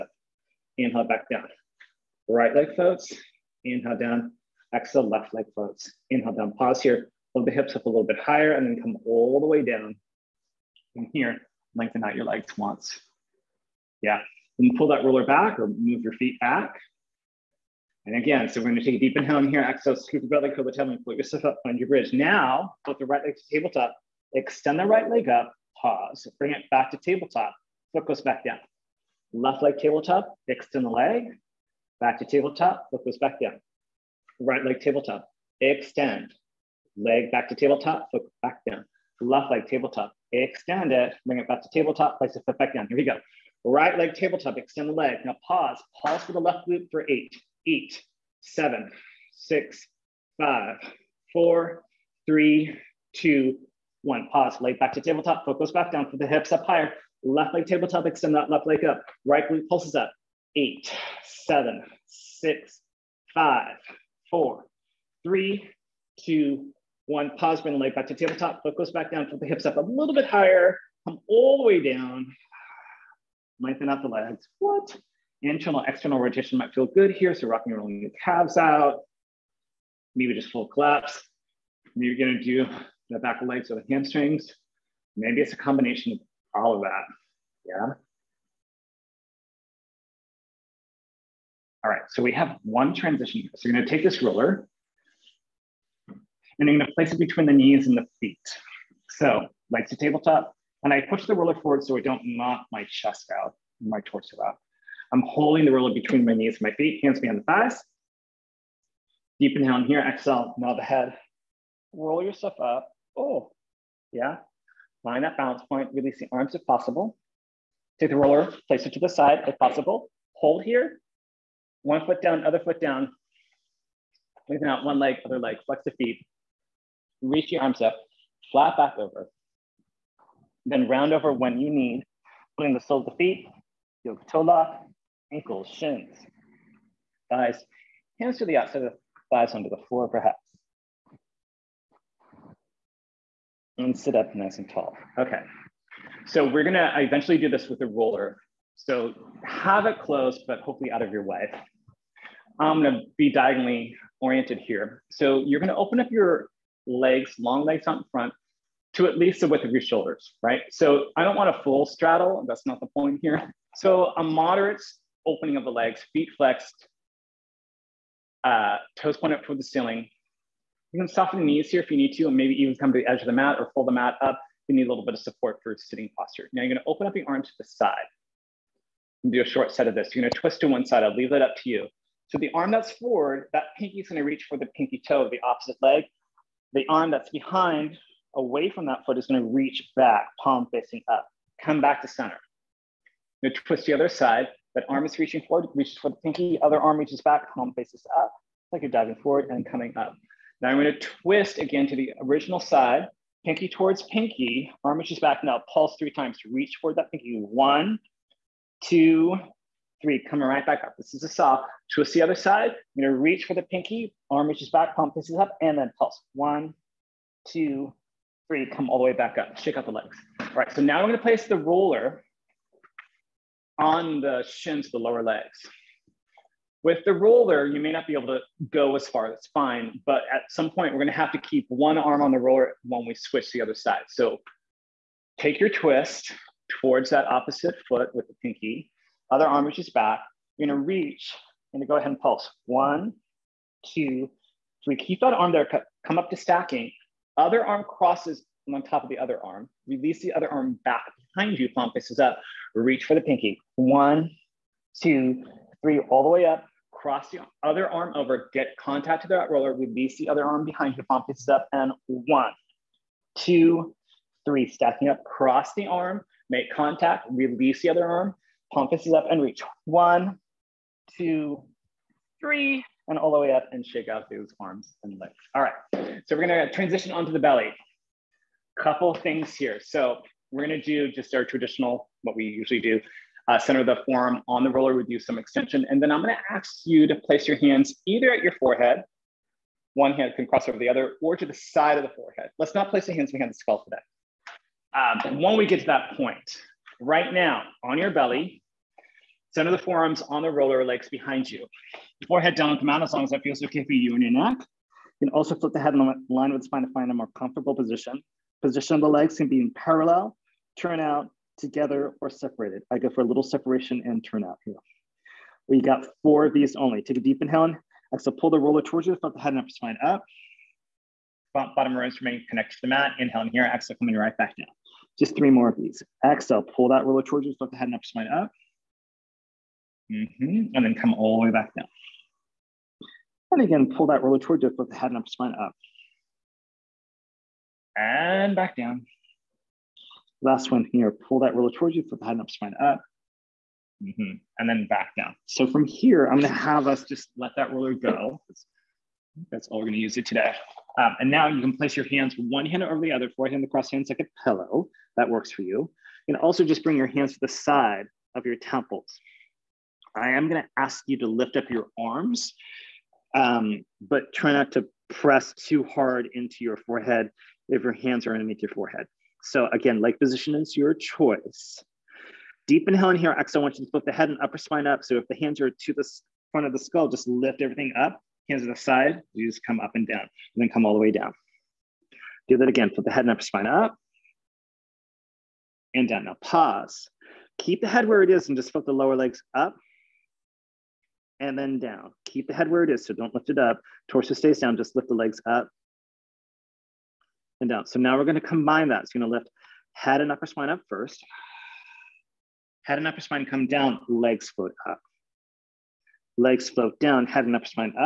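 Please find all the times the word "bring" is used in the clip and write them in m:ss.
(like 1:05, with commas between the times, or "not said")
0:26, 0:41, 1:07, 5:56.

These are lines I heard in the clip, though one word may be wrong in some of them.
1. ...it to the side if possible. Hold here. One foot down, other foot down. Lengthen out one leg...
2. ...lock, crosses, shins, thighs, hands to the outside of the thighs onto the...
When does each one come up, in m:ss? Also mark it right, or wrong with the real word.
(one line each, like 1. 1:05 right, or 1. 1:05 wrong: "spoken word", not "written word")
1. 1:58 right
2. 2:14 wrong: "ankles", not "crosses".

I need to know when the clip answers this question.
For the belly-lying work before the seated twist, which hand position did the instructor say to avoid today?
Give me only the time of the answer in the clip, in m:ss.
4:53.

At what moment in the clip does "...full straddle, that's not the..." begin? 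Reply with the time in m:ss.
2:41.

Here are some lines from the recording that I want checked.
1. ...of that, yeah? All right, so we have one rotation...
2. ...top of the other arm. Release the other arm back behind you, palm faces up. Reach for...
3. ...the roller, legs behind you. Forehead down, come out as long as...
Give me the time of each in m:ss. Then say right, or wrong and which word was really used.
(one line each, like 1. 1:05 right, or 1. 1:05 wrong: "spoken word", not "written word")
1. 1:26 wrong: "transition", not "rotation"
2. 4:08 right
3. 5:00 right.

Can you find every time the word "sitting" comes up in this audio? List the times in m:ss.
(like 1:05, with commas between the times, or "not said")
2:55.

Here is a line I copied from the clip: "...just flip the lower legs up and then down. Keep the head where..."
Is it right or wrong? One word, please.
right.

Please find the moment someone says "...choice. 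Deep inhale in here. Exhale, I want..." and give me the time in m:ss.
6:10.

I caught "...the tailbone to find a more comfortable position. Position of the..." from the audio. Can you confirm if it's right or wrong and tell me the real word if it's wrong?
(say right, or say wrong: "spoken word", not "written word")
wrong: "spine", not "tailbone".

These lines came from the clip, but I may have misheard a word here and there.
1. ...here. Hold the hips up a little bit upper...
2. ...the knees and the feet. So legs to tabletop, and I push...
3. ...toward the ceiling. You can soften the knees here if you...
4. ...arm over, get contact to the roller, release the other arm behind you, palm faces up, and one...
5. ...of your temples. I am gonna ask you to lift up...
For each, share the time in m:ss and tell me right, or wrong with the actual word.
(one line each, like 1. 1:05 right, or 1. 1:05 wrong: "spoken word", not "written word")
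1. 0:06 wrong: "higher", not "upper"
2. 1:37 right
3. 2:49 right
4. 4:17 right
5. 5:58 right.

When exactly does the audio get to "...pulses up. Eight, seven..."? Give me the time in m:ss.
0:59.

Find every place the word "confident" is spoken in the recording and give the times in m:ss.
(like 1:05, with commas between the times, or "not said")
not said.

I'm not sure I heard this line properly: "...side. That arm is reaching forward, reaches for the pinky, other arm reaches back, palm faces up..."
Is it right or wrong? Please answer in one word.
right.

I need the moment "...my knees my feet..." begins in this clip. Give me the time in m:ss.
1:46.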